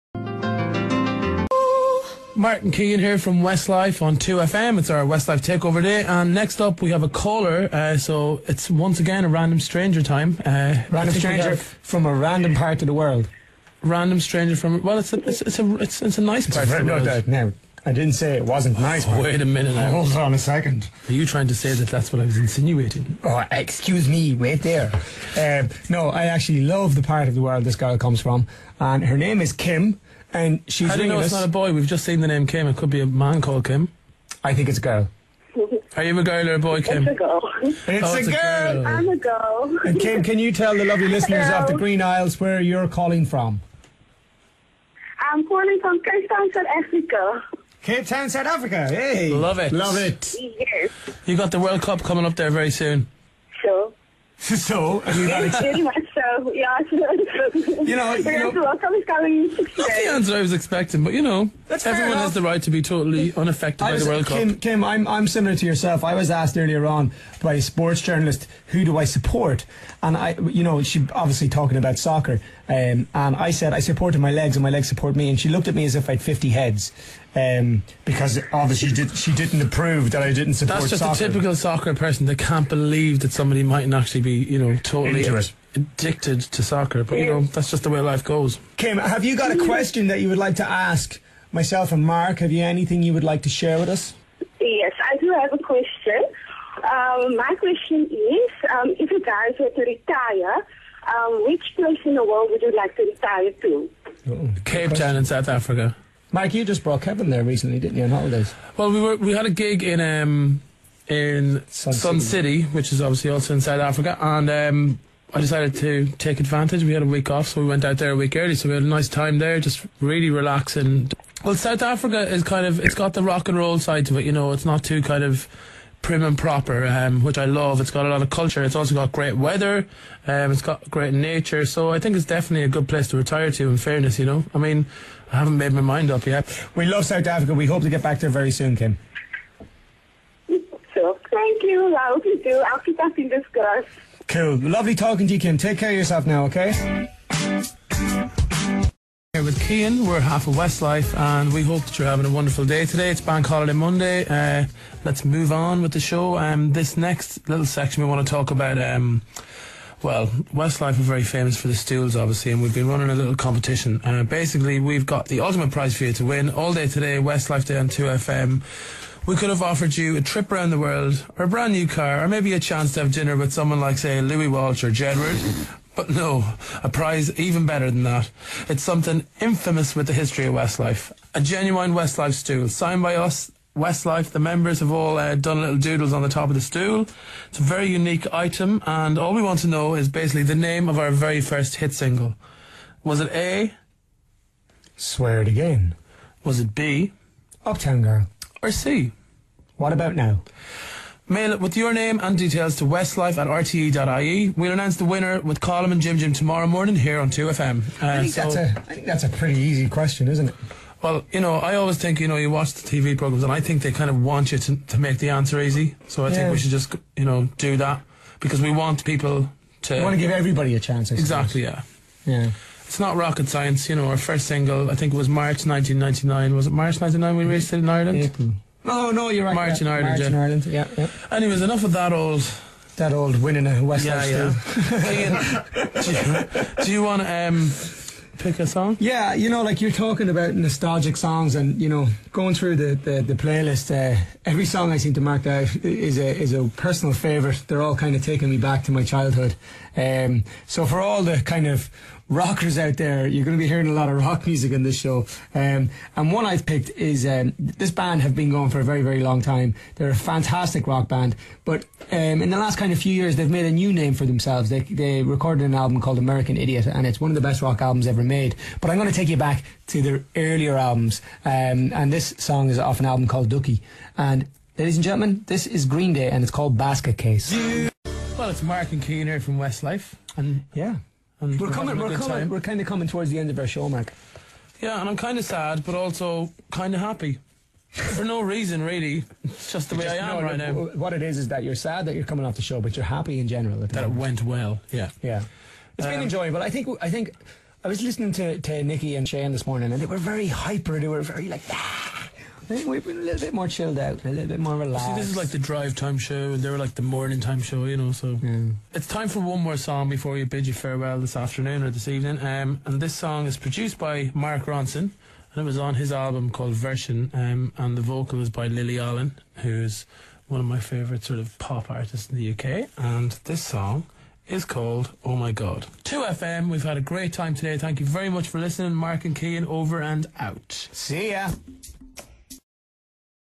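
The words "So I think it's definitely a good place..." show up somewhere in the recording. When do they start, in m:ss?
2:11.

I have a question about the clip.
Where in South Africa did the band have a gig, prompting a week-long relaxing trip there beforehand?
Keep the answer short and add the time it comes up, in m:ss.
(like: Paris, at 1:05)
Sun City, at 1:51.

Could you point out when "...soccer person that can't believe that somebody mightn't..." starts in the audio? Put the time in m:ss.
1:21.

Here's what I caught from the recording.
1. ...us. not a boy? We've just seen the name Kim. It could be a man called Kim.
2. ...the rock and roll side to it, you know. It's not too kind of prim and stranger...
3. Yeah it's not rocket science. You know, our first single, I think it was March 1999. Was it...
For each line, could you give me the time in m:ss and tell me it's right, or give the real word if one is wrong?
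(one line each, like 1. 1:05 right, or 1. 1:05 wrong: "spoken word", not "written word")
1. 0:31 right
2. 2:03 wrong: "proper", not "stranger"
3. 3:42 right.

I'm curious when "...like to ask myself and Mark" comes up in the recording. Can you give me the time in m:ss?
1:30.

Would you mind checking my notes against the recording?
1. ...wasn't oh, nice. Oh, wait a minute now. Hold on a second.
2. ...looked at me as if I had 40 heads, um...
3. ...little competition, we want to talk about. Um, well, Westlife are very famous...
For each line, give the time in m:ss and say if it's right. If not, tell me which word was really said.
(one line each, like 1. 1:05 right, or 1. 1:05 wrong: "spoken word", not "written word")
1. 0:18 right
2. 1:15 wrong: "50", not "40"
3. 2:37 wrong: "section", not "competition".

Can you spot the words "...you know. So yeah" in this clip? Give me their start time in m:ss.
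5:07.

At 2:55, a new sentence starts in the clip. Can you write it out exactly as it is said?
But no, a prize even better than that.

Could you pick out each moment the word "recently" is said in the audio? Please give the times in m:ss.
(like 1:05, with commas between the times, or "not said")
1:47.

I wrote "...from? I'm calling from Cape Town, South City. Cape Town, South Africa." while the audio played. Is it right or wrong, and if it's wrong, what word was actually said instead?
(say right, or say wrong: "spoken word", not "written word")
wrong: "Africa", not "City".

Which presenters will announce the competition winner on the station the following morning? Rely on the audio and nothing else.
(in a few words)
Colm and Jim Jim.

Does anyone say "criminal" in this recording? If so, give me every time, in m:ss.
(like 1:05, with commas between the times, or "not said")
not said.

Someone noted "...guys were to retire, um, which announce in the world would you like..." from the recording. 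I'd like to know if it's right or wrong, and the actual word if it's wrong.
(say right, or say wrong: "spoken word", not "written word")
wrong: "place", not "announce".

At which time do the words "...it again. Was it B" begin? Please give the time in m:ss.
3:15.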